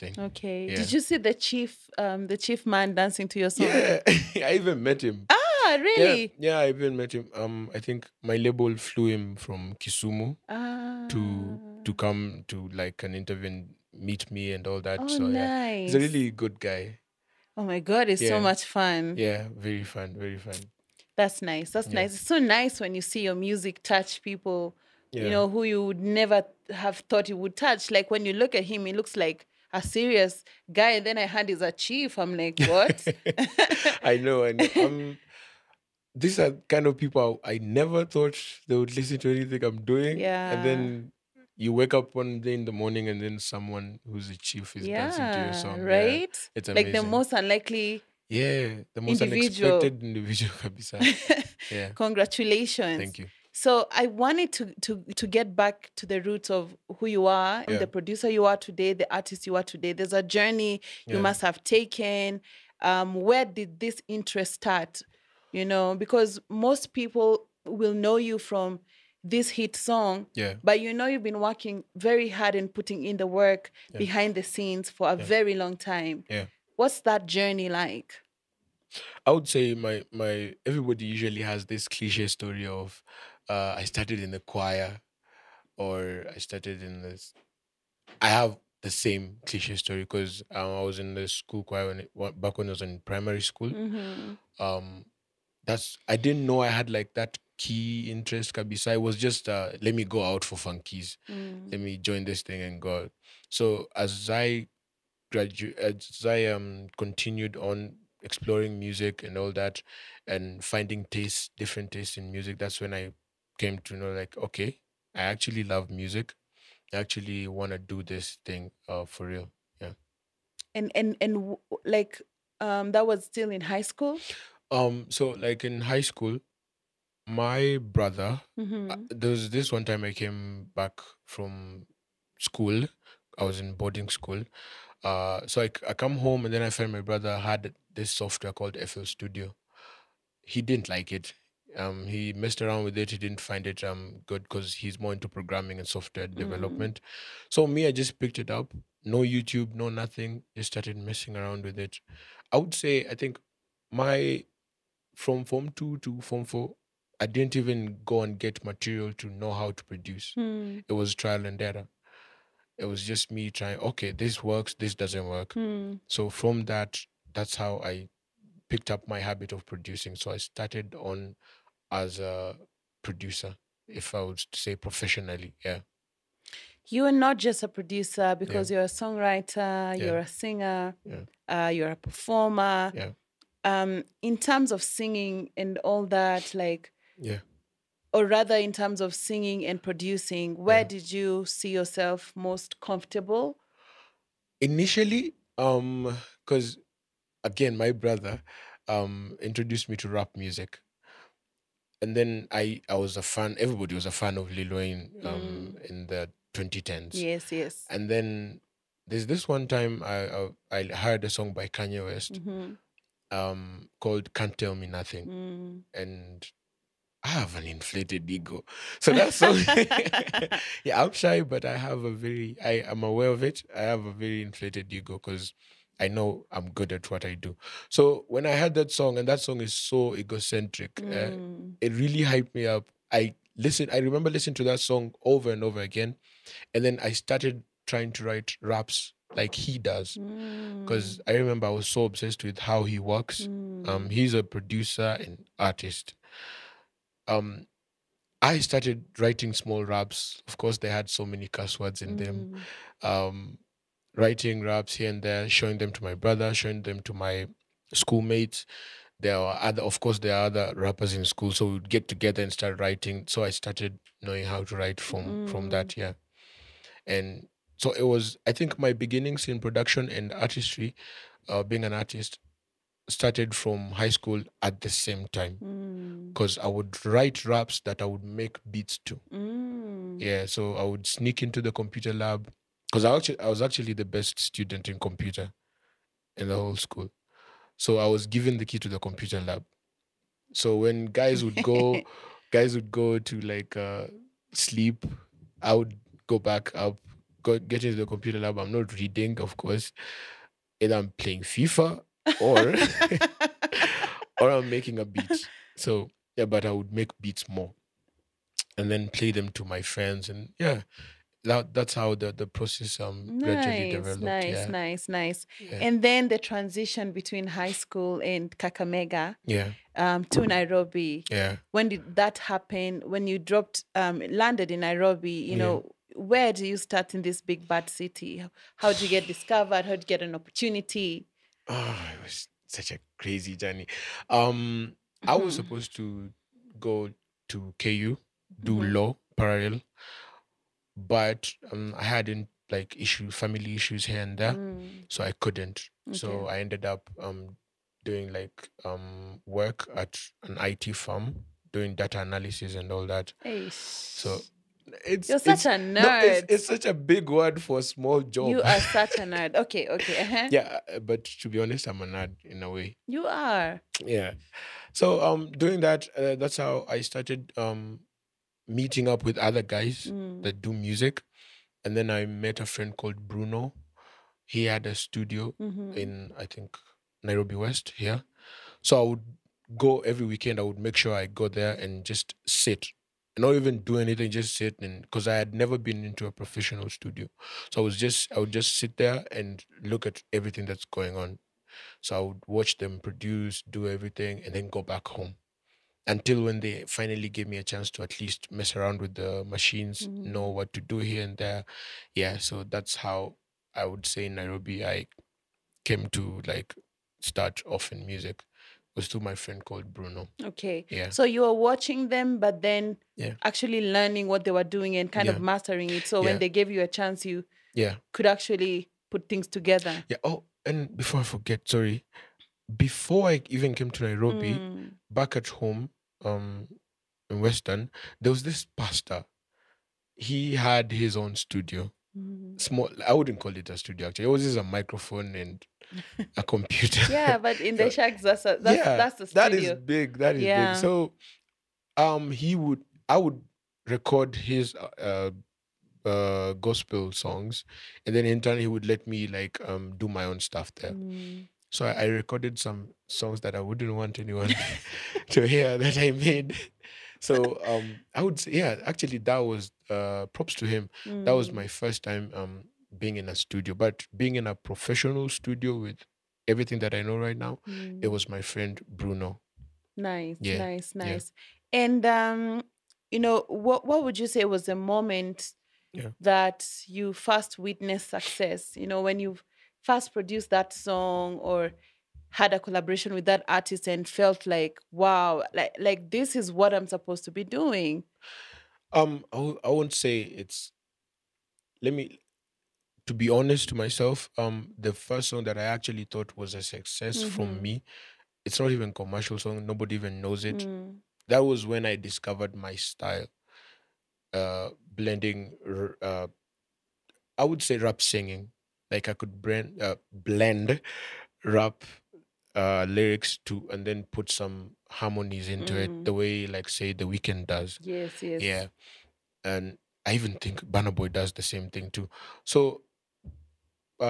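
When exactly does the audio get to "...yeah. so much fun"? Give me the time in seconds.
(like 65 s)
18 s.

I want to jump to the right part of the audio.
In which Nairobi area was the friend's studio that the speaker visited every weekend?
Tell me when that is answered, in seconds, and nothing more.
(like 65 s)
377 s.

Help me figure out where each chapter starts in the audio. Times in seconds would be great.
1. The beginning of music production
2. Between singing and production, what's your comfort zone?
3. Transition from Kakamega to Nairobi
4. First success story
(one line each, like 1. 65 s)
1. 55 s
2. 183 s
3. 315 s
4. 352 s.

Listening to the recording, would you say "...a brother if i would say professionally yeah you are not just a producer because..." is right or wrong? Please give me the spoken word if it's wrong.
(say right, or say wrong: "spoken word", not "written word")
wrong: "producer", not "brother".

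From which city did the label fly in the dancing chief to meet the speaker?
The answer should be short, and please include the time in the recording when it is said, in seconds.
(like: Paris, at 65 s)
Kisumu, at 9 s.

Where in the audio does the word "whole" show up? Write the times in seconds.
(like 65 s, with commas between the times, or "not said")
286 s.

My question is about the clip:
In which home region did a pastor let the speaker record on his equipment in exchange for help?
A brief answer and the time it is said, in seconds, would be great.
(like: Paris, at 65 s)
Western, at 427 s.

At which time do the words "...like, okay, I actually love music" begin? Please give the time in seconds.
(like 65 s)
114 s.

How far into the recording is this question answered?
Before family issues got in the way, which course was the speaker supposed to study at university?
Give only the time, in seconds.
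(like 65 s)
338 s.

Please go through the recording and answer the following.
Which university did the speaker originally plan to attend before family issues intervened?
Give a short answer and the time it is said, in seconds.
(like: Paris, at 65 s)
KU, at 337 s.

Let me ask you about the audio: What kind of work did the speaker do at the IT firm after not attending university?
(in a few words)
data analysis.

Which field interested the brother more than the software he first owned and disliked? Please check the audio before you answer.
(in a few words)
programming.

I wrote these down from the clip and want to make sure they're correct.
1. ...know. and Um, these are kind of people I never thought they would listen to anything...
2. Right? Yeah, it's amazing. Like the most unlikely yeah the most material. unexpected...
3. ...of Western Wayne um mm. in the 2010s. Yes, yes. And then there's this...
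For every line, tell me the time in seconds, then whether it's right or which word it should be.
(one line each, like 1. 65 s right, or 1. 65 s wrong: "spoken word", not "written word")
1. 34 s right
2. 45 s wrong: "individual", not "material"
3. 204 s wrong: "Lil", not "Western".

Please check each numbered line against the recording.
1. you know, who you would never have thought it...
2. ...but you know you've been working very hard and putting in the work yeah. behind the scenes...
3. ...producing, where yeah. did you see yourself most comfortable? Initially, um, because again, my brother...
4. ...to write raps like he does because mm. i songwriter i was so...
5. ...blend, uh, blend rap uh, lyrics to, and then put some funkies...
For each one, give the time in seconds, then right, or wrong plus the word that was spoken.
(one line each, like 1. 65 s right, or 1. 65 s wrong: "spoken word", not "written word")
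1. 25 s right
2. 70 s right
3. 189 s right
4. 238 s wrong: "remember", not "songwriter"
5. 509 s wrong: "harmonies", not "funkies".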